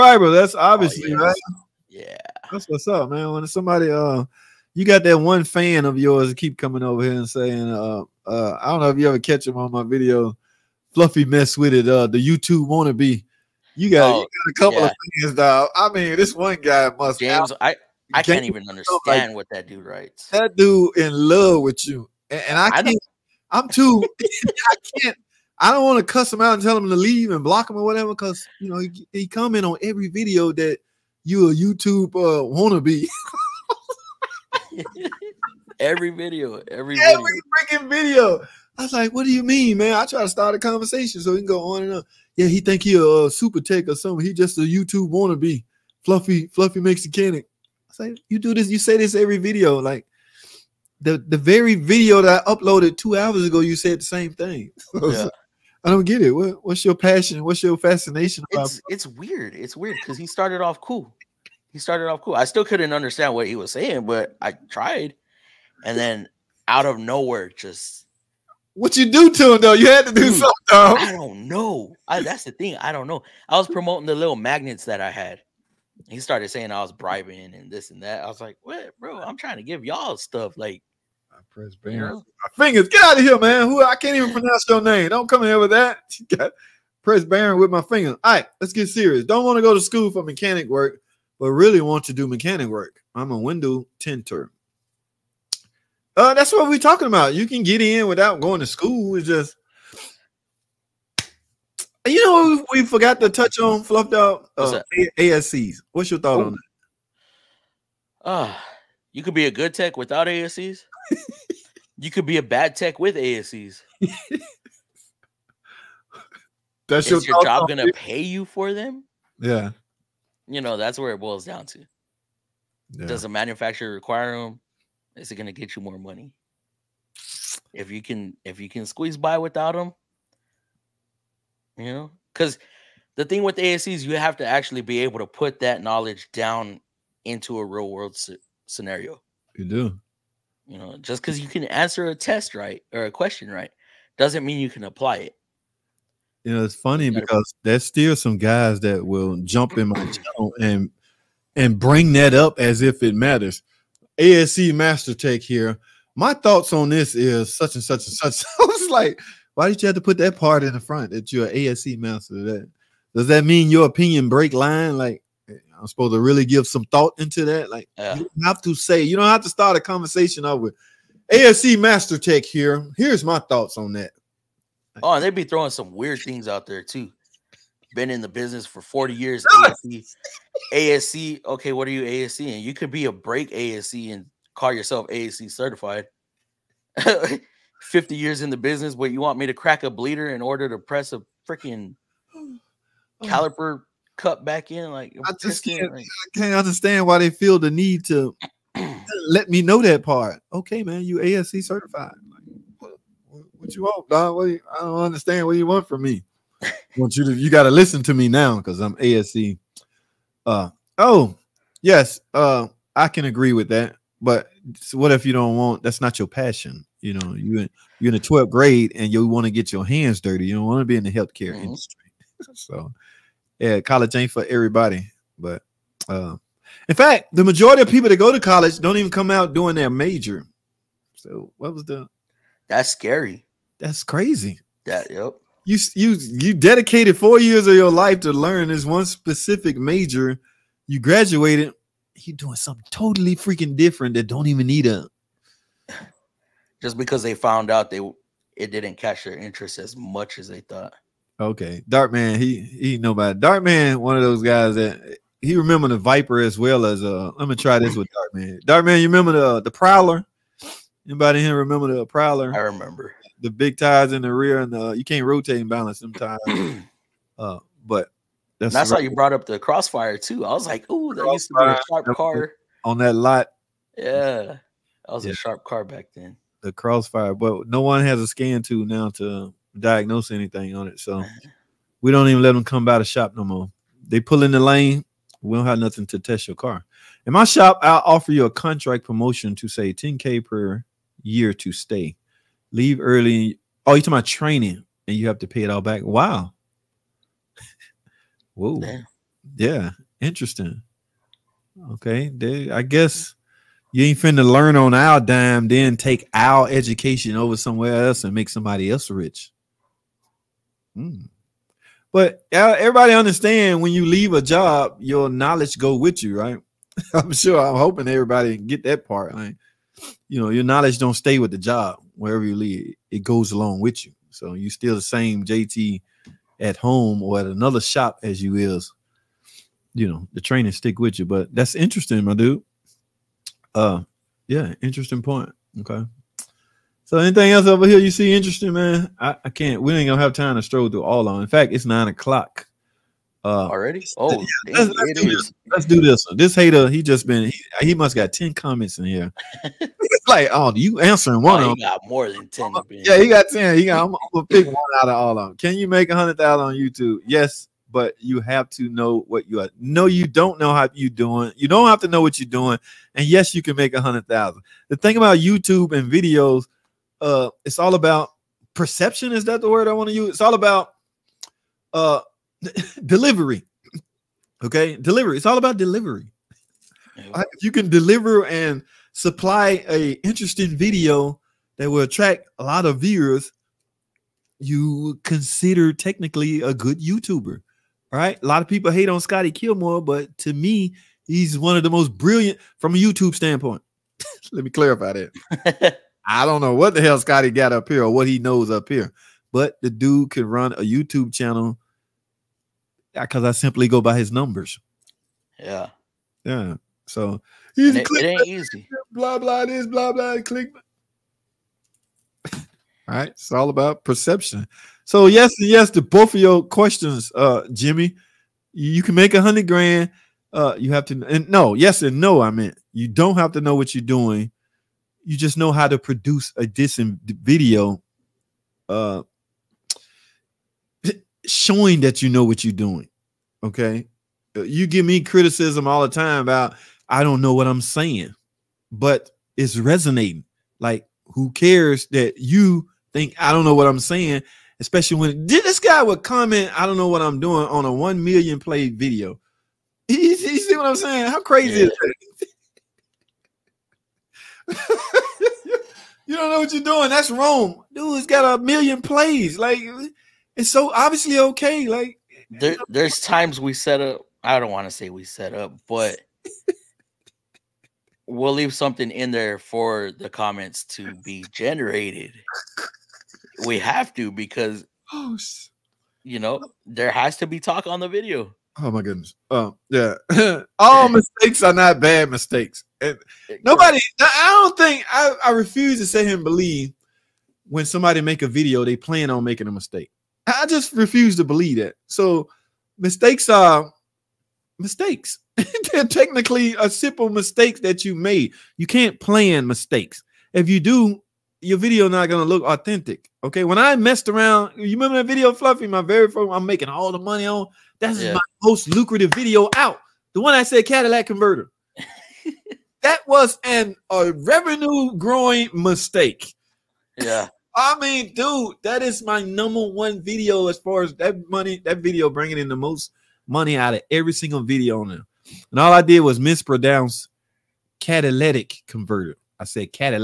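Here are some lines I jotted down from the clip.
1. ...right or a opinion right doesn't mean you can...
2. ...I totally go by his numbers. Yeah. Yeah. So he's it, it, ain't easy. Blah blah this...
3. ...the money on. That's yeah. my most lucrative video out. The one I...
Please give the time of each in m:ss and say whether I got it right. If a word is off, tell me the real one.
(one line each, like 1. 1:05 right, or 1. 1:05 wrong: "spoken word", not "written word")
1. 2:22 wrong: "question", not "opinion"
2. 6:43 wrong: "simply", not "totally"
3. 8:27 right.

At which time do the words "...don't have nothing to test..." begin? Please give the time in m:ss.
4:45.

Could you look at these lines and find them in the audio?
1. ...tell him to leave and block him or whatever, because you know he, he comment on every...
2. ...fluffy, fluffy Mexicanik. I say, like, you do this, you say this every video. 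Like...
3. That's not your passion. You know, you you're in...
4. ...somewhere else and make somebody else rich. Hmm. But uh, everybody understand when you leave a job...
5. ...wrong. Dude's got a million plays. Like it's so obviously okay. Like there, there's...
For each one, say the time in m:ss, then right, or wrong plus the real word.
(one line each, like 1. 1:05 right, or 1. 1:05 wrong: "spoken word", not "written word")
1. 0:26 right
2. 0:46 right
3. 3:35 right
4. 5:07 right
5. 7:37 right.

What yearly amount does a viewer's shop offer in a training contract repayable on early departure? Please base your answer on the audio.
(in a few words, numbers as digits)
10k.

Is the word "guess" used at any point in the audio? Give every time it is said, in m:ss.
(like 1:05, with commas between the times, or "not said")
5:02.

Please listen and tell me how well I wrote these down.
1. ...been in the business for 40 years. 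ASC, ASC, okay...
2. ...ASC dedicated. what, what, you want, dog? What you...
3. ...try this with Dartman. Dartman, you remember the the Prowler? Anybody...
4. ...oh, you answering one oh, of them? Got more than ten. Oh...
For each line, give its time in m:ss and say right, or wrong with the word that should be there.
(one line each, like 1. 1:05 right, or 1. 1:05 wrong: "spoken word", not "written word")
1. 2:57 right
2. 3:21 wrong: "certified", not "dedicated"
3. 4:17 right
4. 5:50 right.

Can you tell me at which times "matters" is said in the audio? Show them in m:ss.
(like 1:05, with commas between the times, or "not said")
2:33.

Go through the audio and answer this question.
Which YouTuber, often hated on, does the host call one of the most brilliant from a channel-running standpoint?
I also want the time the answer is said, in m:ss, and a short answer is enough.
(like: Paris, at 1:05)
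Scotty Kilmer, at 6:29.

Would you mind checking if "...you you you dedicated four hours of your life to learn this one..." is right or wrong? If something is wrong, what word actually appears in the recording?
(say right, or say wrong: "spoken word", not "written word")
wrong: "years", not "hours".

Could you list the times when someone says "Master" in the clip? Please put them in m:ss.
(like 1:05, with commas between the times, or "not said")
2:34, 2:41, 2:51.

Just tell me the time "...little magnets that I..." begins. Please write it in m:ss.
1:14.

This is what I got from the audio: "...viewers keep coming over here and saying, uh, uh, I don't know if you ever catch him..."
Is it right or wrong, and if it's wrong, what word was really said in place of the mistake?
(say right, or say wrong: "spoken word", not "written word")
wrong: "yours", not "viewers".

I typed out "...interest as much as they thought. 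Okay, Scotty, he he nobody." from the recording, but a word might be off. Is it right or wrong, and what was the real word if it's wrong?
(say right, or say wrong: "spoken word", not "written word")
wrong: "Dartman", not "Scotty".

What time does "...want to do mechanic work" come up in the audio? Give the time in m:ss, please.
1:31.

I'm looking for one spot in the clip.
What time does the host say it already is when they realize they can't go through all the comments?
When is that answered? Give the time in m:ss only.
5:41.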